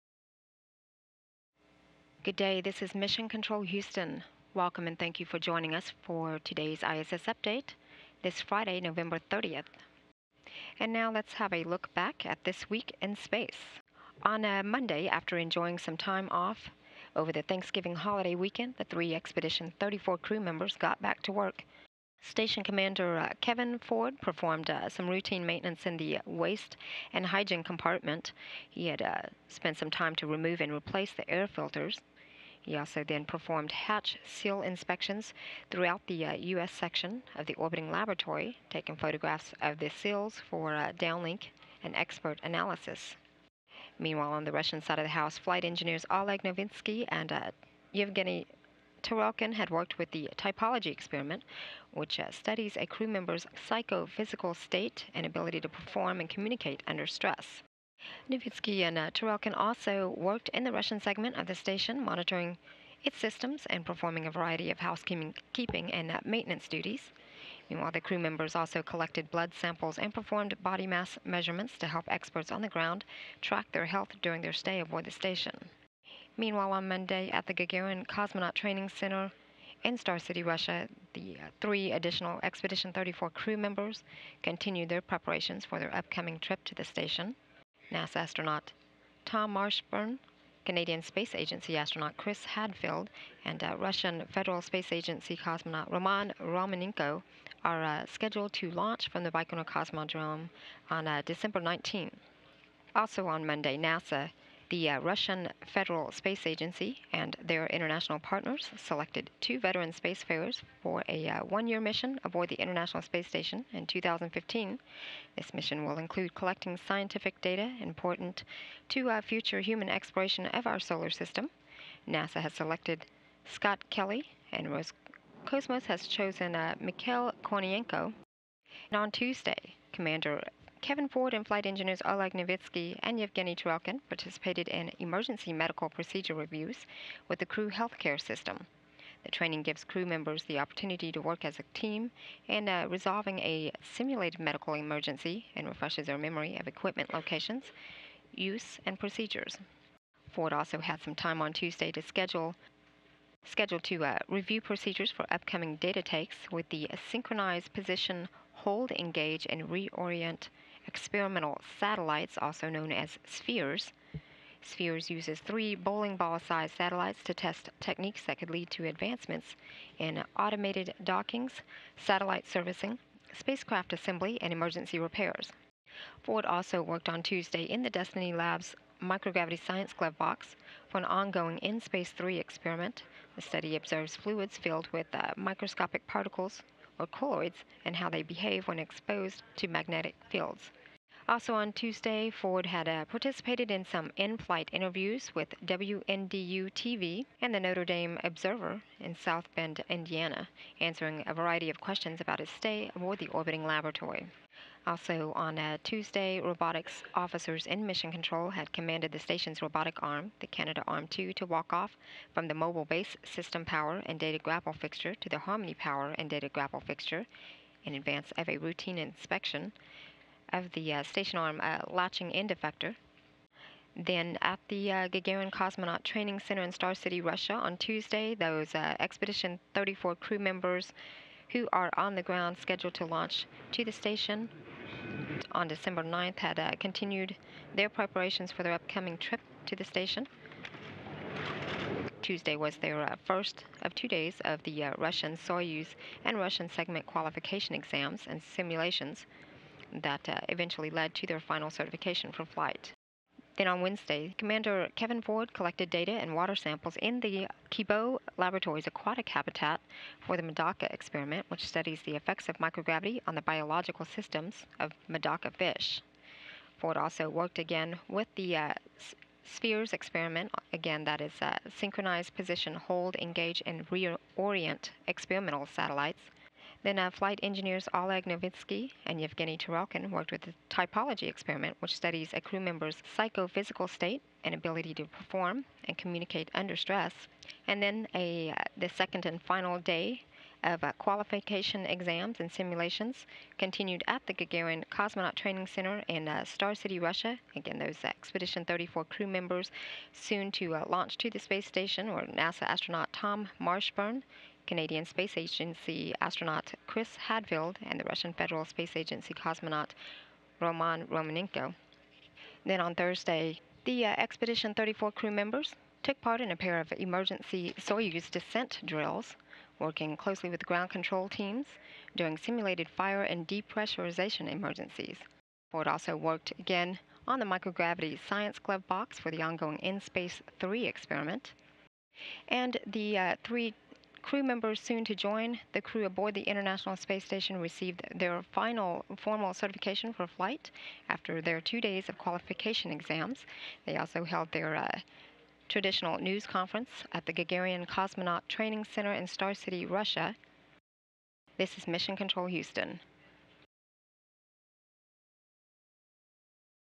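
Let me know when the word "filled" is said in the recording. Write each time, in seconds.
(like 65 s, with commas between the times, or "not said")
184 s.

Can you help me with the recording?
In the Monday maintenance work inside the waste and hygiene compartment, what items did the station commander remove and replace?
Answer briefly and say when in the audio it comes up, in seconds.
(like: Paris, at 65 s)
air filters, at 31 s.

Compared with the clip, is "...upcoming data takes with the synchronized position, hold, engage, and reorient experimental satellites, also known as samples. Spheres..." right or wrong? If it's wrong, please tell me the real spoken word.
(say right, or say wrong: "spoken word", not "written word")
wrong: "spheres", not "samples".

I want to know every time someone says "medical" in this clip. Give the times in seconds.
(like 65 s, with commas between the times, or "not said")
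135 s, 144 s.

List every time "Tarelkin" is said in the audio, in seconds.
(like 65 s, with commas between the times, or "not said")
49 s, 59 s, 133 s, 279 s.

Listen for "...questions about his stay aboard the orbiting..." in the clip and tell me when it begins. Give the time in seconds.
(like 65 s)
201 s.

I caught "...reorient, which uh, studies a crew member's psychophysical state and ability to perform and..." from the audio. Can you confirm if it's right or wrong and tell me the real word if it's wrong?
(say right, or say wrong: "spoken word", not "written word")
wrong: "experiment", not "reorient".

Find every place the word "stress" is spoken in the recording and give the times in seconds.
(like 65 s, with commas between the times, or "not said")
57 s, 286 s.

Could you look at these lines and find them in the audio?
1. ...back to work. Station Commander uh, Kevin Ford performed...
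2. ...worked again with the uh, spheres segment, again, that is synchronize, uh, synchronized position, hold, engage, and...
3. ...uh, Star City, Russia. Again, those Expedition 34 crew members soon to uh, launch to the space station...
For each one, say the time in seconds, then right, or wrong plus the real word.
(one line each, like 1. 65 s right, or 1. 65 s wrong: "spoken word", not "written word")
1. 21 s right
2. 267 s wrong: "experiment", not "segment"
3. 296 s right.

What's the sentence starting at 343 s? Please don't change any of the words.
They also held their uh, traditional news conference at the Gagarin Cosmonaut Training Center in Star City, Russia.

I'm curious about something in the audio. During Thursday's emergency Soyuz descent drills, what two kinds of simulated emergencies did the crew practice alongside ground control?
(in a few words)
fire and depressurization.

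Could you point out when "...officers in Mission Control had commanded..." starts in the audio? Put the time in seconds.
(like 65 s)
207 s.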